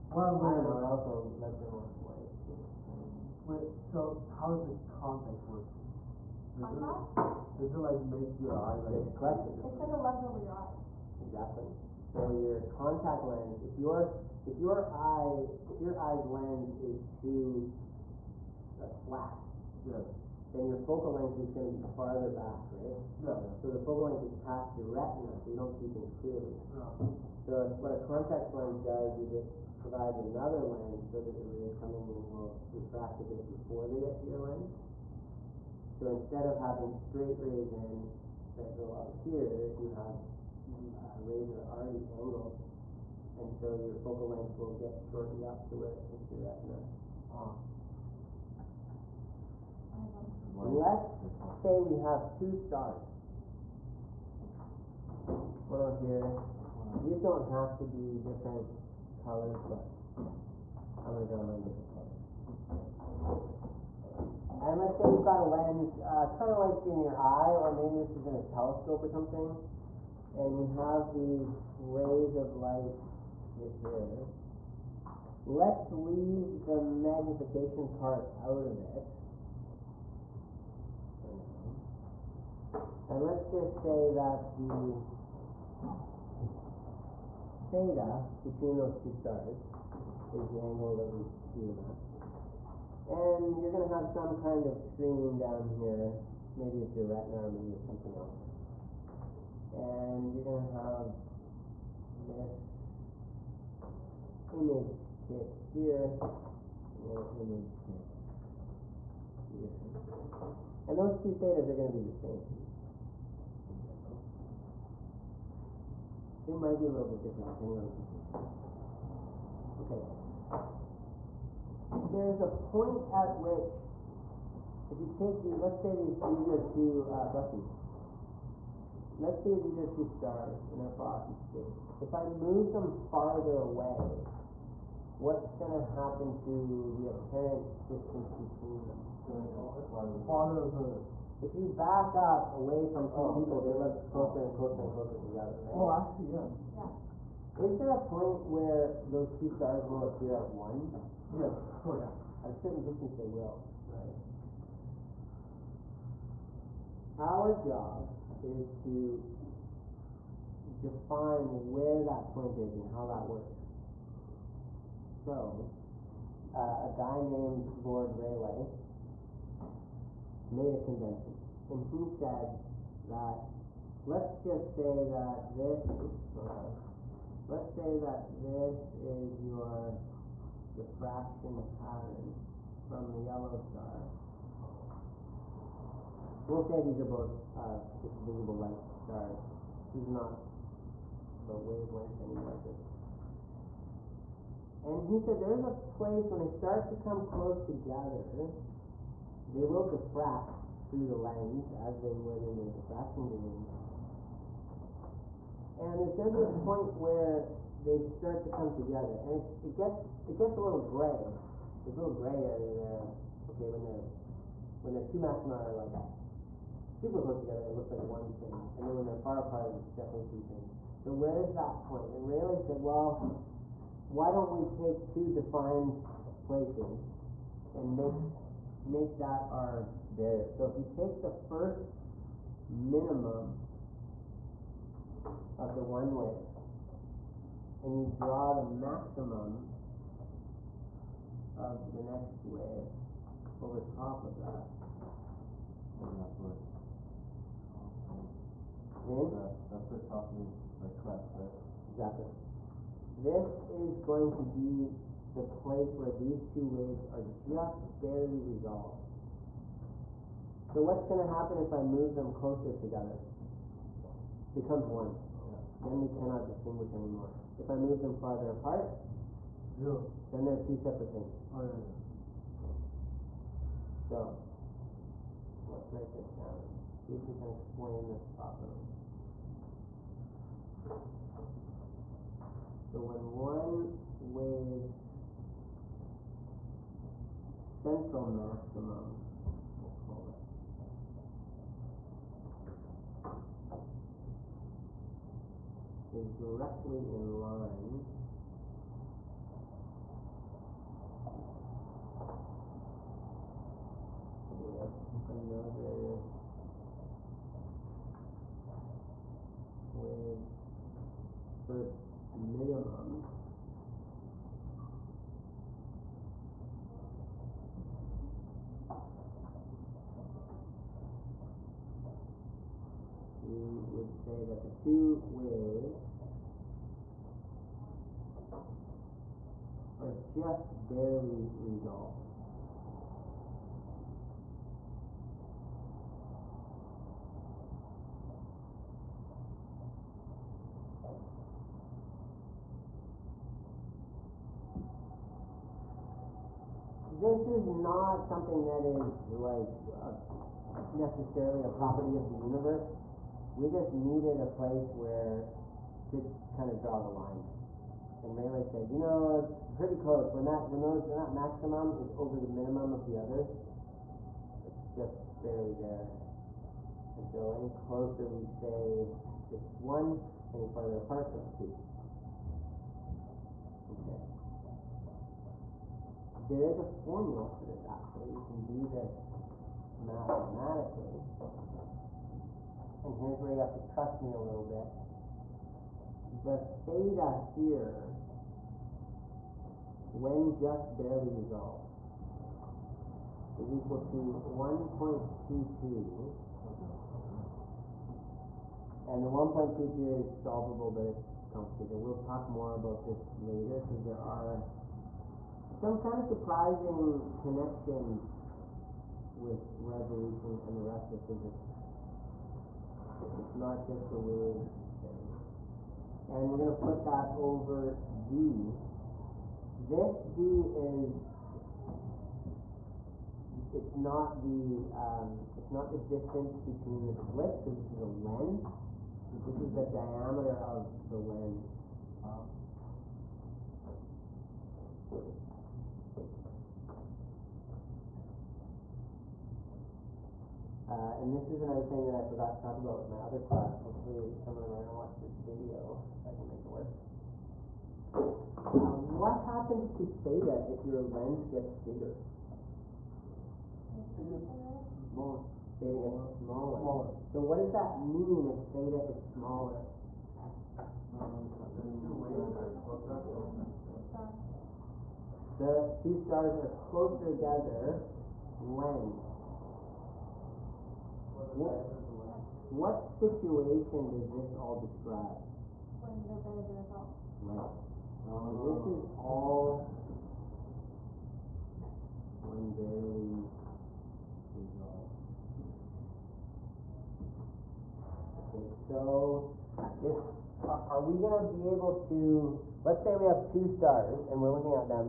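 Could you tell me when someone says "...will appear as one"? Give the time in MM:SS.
02:29.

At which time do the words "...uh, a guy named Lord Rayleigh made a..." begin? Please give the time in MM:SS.
02:46.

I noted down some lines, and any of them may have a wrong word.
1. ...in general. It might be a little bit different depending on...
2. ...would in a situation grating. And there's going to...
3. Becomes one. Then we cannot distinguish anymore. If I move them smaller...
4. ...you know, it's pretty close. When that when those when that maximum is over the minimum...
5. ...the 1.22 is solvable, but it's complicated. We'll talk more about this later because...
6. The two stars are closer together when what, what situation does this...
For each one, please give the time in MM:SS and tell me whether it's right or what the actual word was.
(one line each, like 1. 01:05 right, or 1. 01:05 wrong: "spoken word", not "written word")
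1. 01:53 right
2. 03:22 wrong: "diffraction", not "situation"
3. 04:24 wrong: "farther", not "smaller"
4. 05:58 right
5. 06:39 right
6. 07:45 right.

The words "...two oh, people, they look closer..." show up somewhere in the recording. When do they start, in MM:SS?
02:23.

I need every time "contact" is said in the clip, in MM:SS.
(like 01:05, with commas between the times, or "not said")
00:04, 00:12, 00:27.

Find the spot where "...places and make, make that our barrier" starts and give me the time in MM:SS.
03:46.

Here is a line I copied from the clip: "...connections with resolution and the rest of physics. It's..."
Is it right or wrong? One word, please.
right.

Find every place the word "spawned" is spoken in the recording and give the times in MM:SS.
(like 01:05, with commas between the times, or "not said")
not said.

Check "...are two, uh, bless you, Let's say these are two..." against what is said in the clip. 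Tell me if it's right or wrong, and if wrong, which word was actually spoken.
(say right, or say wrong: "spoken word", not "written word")
right.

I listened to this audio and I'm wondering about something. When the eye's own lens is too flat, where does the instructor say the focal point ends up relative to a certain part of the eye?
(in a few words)
Past your retina.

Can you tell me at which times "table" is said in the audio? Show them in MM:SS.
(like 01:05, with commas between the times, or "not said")
not said.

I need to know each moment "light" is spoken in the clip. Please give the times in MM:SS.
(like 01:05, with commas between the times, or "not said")
00:02, 01:12, 03:08.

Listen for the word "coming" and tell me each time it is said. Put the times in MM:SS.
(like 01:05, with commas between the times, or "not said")
00:31.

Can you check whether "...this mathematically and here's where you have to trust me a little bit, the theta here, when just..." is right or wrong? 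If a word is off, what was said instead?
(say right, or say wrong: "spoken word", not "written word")
right.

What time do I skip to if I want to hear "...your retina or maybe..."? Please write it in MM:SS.
01:36.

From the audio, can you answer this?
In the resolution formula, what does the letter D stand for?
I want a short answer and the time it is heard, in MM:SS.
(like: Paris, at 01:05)
Diameter of the lens, at 07:09.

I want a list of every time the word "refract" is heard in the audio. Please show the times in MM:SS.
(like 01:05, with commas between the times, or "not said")
00:32.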